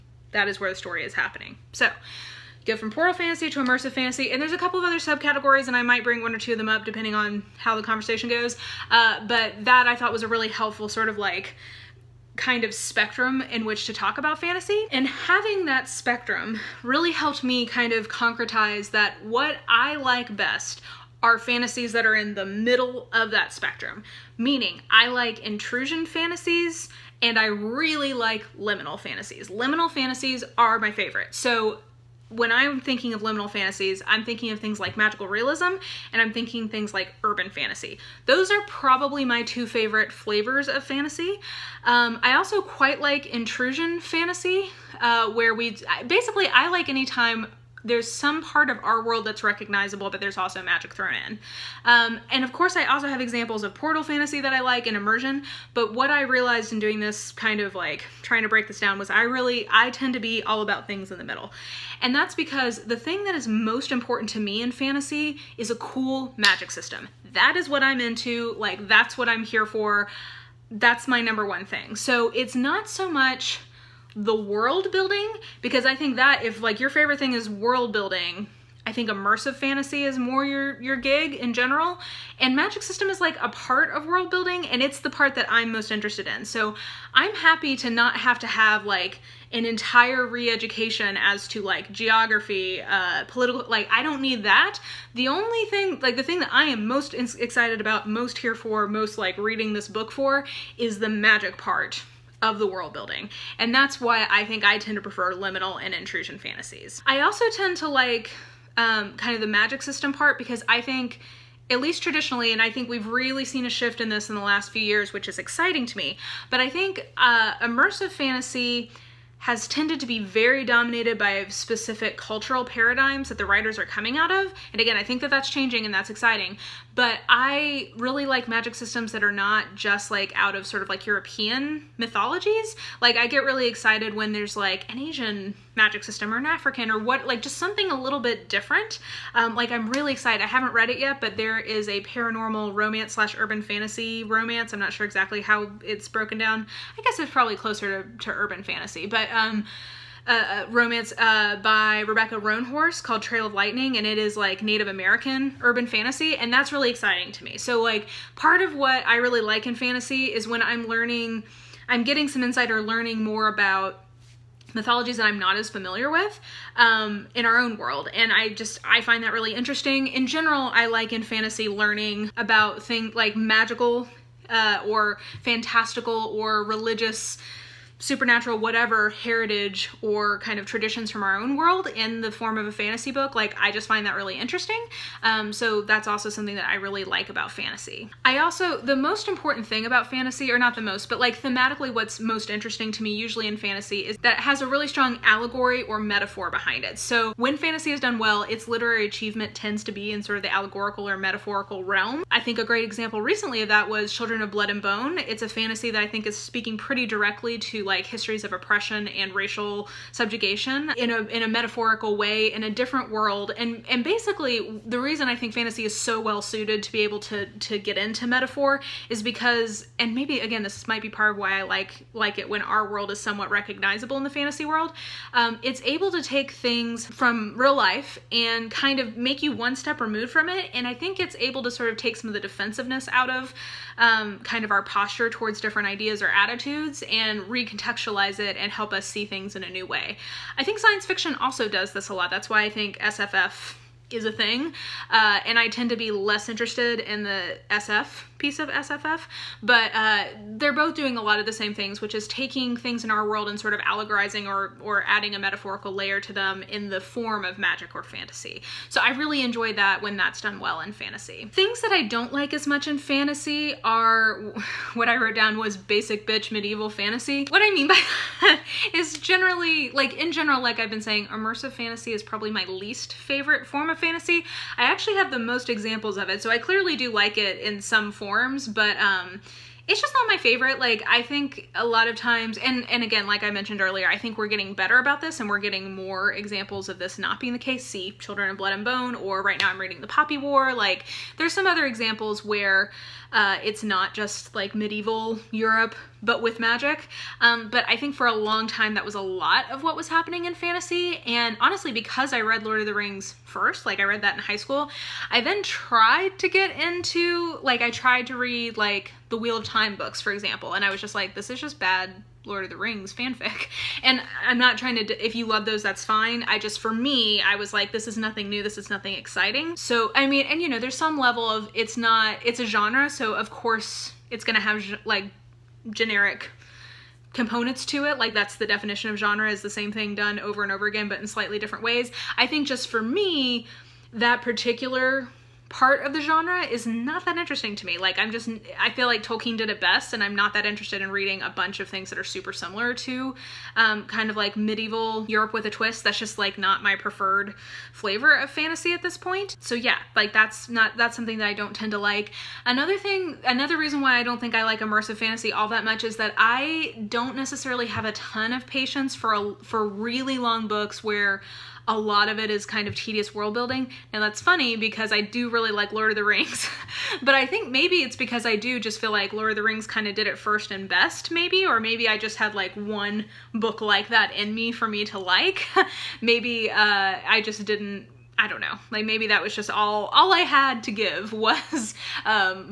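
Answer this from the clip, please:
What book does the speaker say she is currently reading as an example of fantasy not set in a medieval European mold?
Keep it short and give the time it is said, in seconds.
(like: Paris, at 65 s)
The Poppy War, at 290 s.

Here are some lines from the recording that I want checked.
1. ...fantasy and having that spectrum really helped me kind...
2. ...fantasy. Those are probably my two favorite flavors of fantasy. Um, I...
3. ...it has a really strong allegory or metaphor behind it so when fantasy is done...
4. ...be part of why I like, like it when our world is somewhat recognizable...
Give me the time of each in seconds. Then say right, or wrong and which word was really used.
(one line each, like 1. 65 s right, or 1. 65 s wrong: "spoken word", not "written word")
1. 14 s right
2. 37 s right
3. 194 s right
4. 221 s right.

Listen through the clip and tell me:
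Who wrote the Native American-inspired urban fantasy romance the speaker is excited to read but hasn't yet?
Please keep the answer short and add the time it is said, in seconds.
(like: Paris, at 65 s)
Rebecca Roanhorse, at 152 s.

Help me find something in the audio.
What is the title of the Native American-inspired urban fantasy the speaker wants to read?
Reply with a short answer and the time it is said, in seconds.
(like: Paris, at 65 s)
Trail of Lightning, at 153 s.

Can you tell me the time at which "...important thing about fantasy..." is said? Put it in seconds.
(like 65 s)
189 s.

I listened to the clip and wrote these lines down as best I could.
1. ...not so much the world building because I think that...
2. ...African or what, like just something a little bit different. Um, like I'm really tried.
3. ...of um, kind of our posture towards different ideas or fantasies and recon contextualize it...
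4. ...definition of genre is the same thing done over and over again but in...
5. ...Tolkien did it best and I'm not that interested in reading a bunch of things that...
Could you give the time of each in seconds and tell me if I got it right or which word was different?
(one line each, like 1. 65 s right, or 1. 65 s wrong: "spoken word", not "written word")
1. 72 s right
2. 136 s wrong: "excited", not "tried"
3. 233 s wrong: "attitudes", not "fantasies"
4. 328 s right
5. 339 s right.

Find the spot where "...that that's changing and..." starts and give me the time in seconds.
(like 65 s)
125 s.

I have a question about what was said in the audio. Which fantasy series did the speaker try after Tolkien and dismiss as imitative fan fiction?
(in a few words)
the Wheel of Time.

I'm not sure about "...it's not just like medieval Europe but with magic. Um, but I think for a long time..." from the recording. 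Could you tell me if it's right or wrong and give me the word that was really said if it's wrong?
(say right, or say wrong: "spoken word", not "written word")
right.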